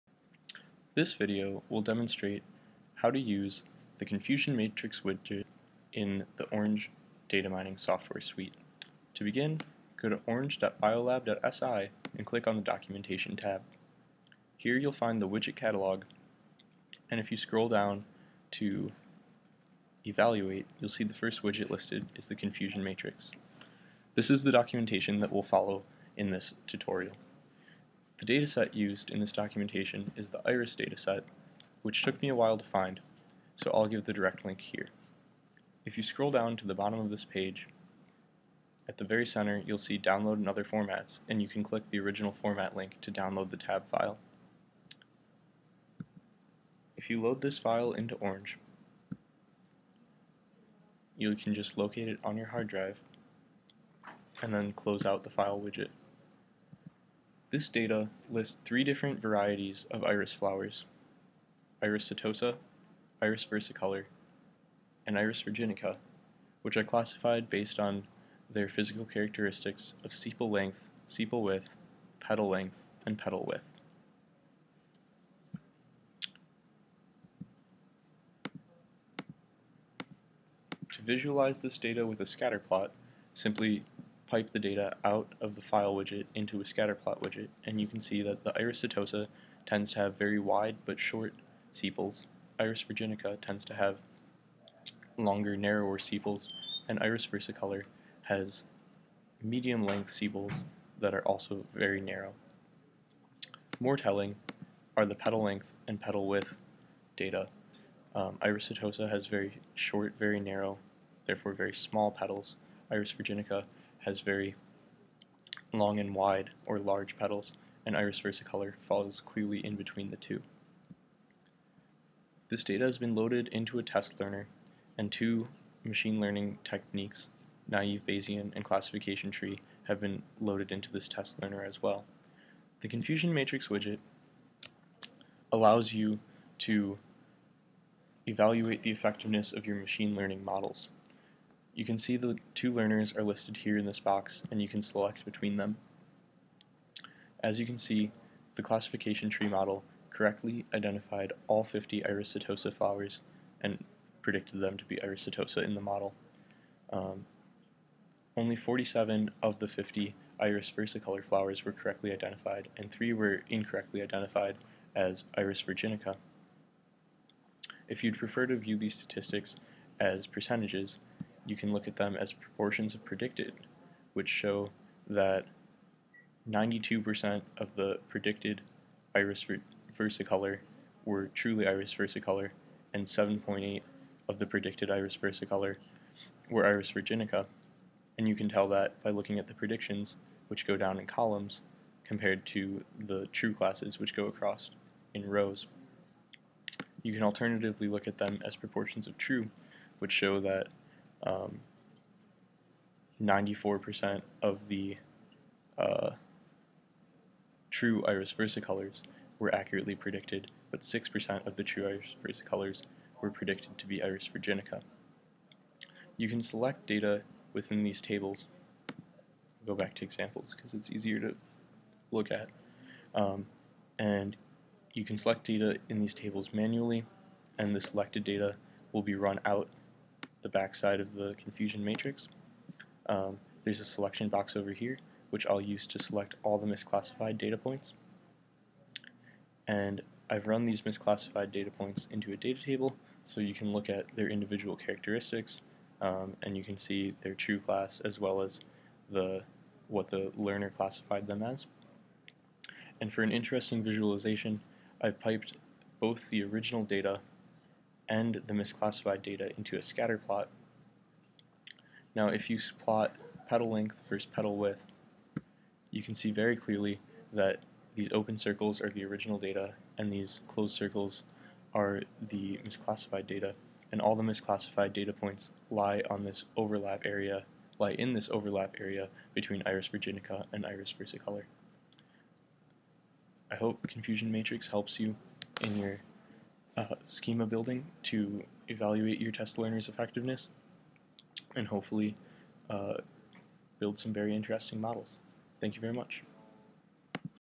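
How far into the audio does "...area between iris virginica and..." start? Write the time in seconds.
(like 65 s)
278 s.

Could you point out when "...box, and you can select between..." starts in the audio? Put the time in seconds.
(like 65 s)
143 s.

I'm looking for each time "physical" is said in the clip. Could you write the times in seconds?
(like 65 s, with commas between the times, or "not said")
68 s.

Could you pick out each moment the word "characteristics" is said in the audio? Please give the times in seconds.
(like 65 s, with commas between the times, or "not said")
69 s, 244 s.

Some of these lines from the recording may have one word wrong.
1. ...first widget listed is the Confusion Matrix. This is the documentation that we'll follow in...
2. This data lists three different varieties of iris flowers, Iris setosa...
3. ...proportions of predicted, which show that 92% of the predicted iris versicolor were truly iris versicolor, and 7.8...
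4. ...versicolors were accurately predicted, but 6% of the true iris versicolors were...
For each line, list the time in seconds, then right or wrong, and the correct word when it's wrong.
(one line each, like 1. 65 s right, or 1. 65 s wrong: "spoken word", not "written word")
1. 21 s right
2. 57 s right
3. 172 s right
4. 208 s right.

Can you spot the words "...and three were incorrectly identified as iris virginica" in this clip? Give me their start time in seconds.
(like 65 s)
162 s.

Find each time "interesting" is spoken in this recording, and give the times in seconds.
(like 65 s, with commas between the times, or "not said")
253 s, 294 s.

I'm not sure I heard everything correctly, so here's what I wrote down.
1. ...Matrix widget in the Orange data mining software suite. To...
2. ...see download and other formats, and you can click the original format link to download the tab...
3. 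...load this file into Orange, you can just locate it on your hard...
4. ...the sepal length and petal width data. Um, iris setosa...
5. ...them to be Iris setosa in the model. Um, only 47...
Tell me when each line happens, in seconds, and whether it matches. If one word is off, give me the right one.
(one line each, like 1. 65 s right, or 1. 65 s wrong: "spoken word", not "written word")
1. 4 s right
2. 39 s right
3. 47 s right
4. 105 s wrong: "petal", not "sepal"
5. 154 s right.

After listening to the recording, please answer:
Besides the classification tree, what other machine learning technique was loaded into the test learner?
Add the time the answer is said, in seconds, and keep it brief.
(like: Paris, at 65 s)
naive Bayesian, at 127 s.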